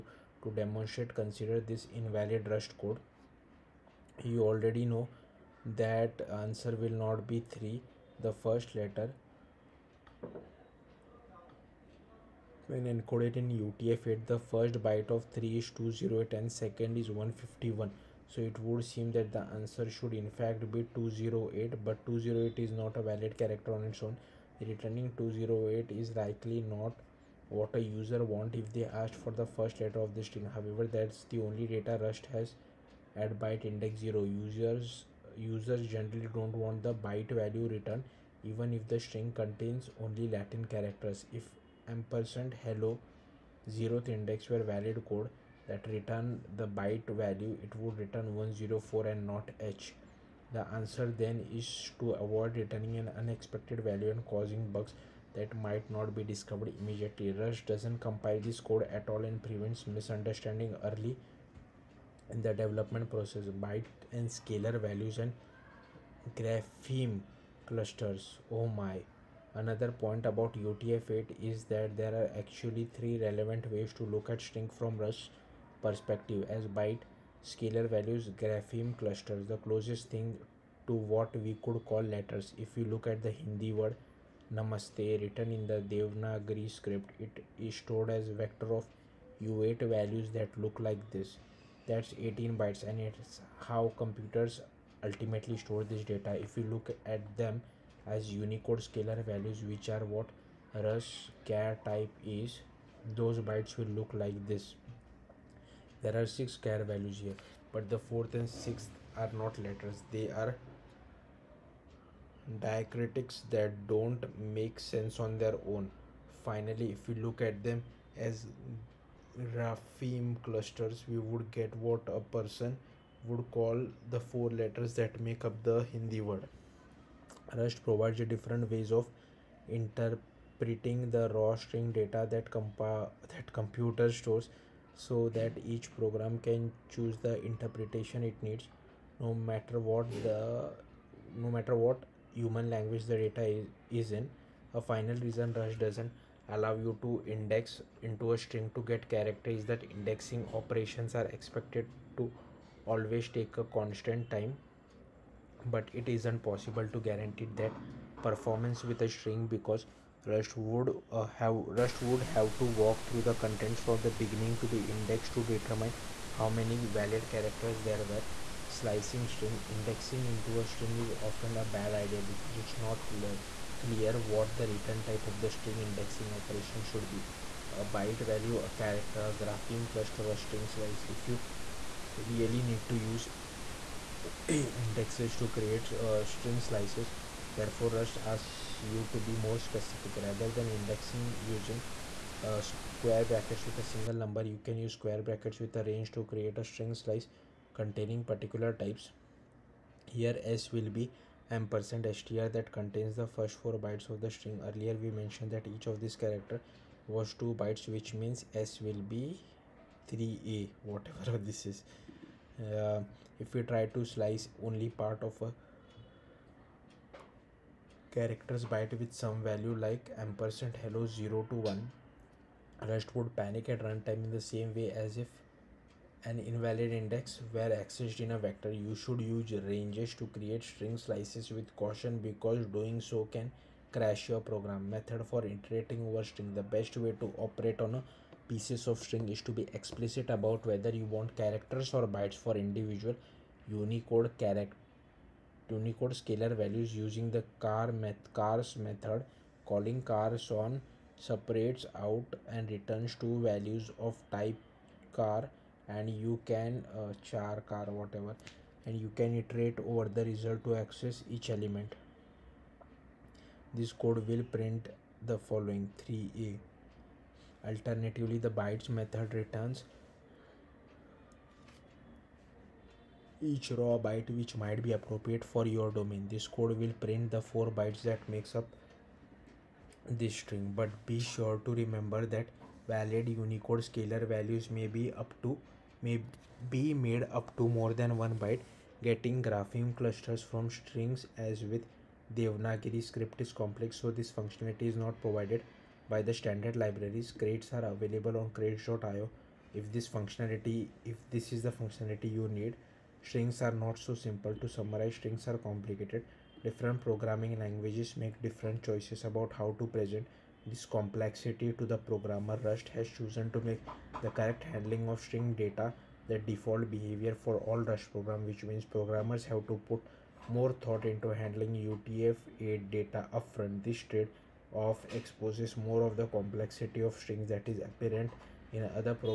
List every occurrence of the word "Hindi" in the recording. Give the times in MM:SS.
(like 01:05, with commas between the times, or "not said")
01:23, 02:05.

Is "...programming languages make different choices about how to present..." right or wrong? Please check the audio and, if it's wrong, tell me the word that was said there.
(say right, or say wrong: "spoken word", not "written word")
right.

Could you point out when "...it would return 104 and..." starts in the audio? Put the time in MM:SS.
00:47.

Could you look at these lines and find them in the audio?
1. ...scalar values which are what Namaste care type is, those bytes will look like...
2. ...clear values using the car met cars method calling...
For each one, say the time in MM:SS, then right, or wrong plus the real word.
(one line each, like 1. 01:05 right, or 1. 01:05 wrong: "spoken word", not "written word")
1. 01:38 wrong: "Rus", not "Namaste"
2. 04:06 wrong: "scalar", not "clear".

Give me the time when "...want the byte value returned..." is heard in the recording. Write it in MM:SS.
00:36.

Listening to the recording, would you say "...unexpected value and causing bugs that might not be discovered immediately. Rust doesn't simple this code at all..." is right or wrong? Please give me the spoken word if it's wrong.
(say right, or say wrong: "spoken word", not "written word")
wrong: "compile", not "simple".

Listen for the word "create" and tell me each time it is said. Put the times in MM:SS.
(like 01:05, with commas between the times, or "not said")
03:05, 03:16, 03:50.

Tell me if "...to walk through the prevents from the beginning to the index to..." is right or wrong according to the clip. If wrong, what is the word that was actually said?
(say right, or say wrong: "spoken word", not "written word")
wrong: "contents", not "prevents".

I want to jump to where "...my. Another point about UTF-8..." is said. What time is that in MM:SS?
01:08.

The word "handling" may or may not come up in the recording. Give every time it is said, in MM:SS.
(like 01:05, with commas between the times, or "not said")
05:14, 05:21.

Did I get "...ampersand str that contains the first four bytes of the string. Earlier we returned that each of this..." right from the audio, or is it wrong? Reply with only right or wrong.
wrong.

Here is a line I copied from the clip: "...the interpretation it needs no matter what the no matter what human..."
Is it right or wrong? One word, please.
right.